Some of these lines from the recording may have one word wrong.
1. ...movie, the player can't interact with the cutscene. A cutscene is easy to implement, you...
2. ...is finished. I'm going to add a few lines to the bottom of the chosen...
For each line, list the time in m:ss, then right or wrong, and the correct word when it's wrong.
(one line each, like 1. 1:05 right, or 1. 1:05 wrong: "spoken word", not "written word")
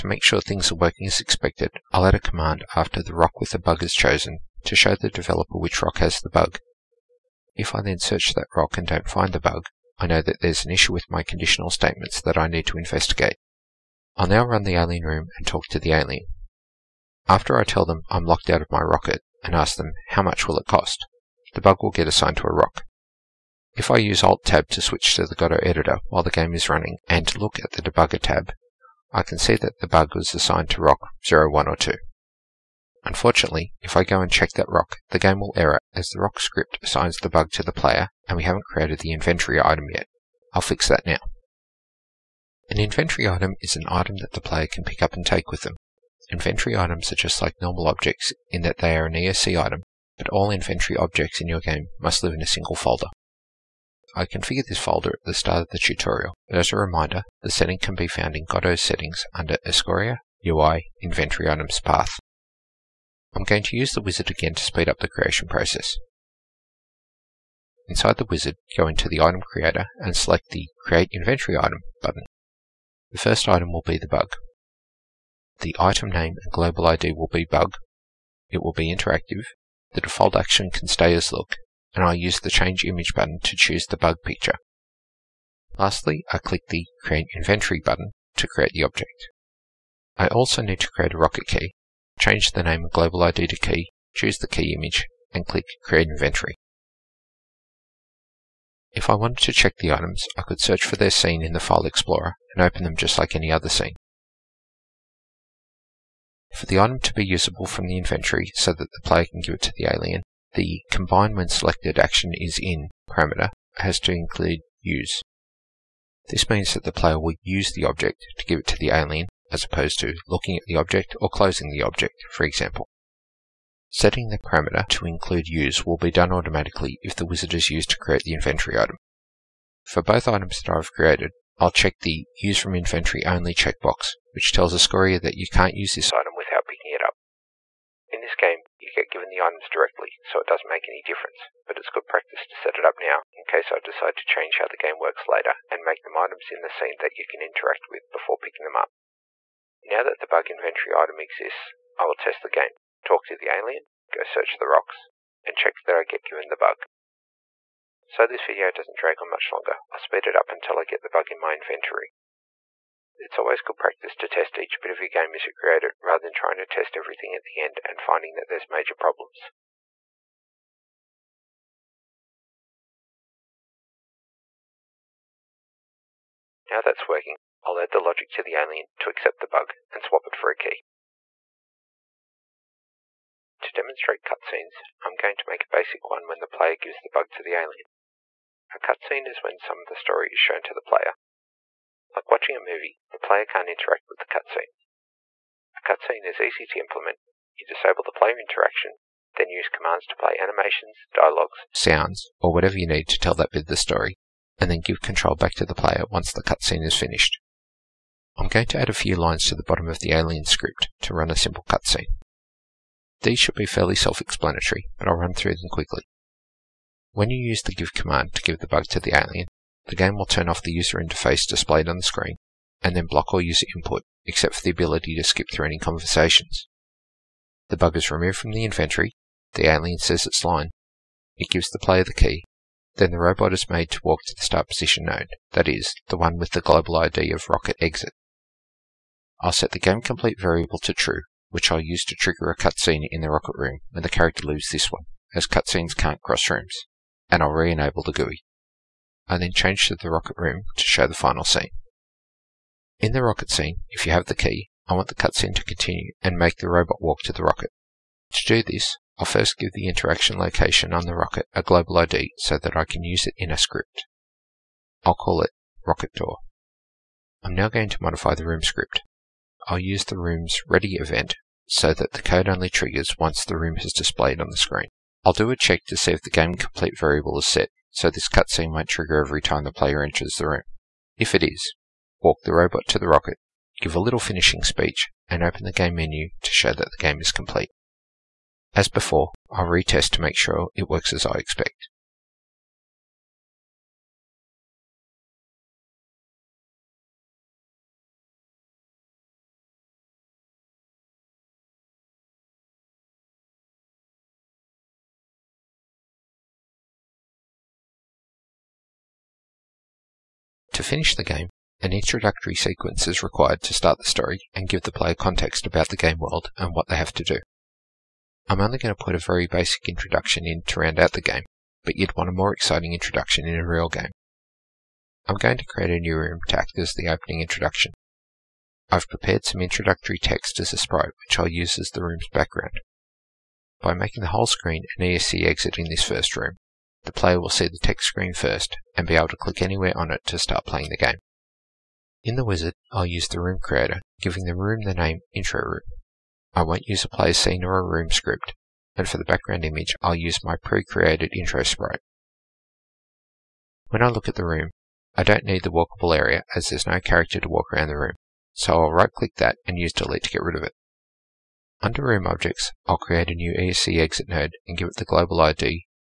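1. 3:12 right
2. 3:26 wrong: "alien", not "chosen".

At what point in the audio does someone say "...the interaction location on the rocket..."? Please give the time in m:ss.
4:19.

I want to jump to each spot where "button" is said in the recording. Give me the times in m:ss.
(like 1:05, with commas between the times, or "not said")
1:12, 1:23, 1:27.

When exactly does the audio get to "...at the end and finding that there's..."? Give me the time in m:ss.
2:47.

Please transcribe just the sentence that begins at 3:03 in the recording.
To demonstrate cutscenes, I'm going to make a basic one when the player gives the bug to the alien.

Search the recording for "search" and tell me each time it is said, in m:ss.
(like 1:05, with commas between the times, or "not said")
0:08, 1:40, 2:34.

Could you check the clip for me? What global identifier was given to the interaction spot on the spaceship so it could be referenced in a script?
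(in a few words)
rocket door.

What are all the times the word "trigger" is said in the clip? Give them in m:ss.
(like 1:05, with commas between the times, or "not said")
4:02, 4:32, 4:38.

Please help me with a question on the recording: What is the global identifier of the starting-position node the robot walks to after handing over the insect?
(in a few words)
rocket exit.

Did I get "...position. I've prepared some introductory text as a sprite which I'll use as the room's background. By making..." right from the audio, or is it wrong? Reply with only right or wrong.
wrong.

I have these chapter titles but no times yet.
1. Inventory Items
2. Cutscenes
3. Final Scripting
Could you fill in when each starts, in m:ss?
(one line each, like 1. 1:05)
1. 0:42
2. 3:02
3. 5:10.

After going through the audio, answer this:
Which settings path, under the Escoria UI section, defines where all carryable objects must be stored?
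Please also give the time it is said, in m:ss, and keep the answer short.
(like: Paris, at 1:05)
Inventory Items Path, at 1:01.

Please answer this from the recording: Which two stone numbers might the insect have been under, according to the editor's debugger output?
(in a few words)
rock 1 or 2.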